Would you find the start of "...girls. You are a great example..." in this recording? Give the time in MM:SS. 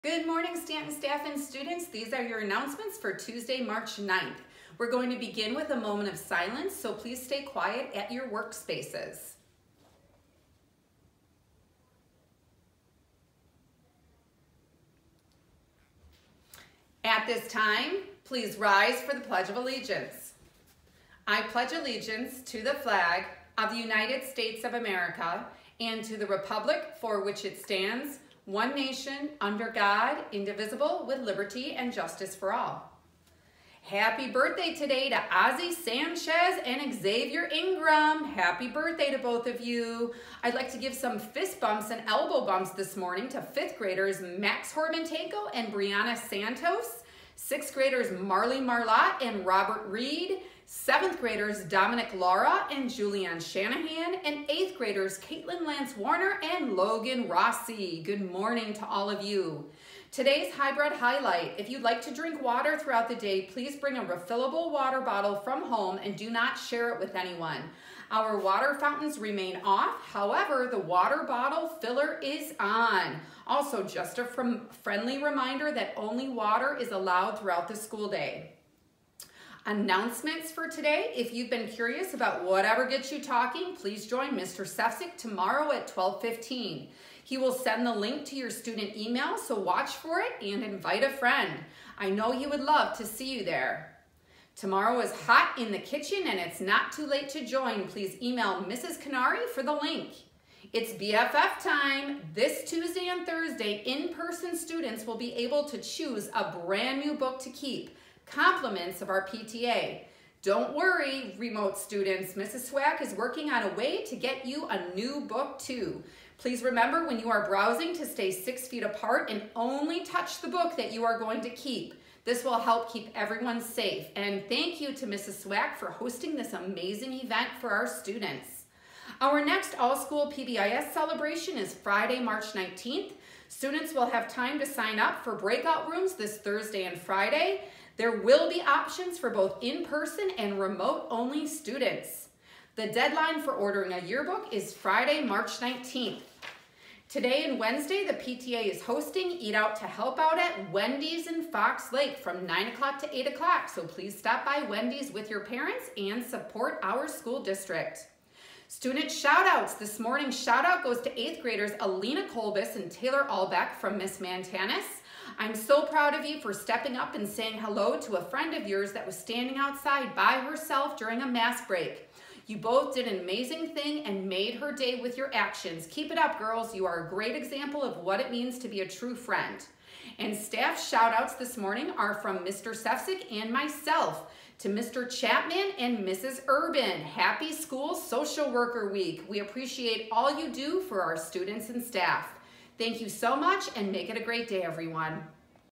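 02:56.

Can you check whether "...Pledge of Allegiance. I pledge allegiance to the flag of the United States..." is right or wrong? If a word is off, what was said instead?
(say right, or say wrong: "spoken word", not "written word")
right.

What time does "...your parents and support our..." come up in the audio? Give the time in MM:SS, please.
02:35.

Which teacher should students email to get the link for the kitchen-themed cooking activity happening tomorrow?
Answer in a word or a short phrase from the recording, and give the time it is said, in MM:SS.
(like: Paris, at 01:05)
Mrs. Canary, at 01:38.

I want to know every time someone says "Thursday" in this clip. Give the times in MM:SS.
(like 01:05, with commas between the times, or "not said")
01:43, 02:16.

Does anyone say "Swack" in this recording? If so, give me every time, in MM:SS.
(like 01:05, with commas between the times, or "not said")
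01:52, 02:05.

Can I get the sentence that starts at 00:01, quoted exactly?
These are your announcements for Tuesday, March 9th.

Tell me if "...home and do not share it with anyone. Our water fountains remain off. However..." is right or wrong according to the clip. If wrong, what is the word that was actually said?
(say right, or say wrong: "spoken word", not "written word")
right.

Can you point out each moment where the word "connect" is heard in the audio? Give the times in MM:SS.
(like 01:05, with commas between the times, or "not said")
not said.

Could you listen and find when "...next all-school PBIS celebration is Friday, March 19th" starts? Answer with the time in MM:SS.
02:09.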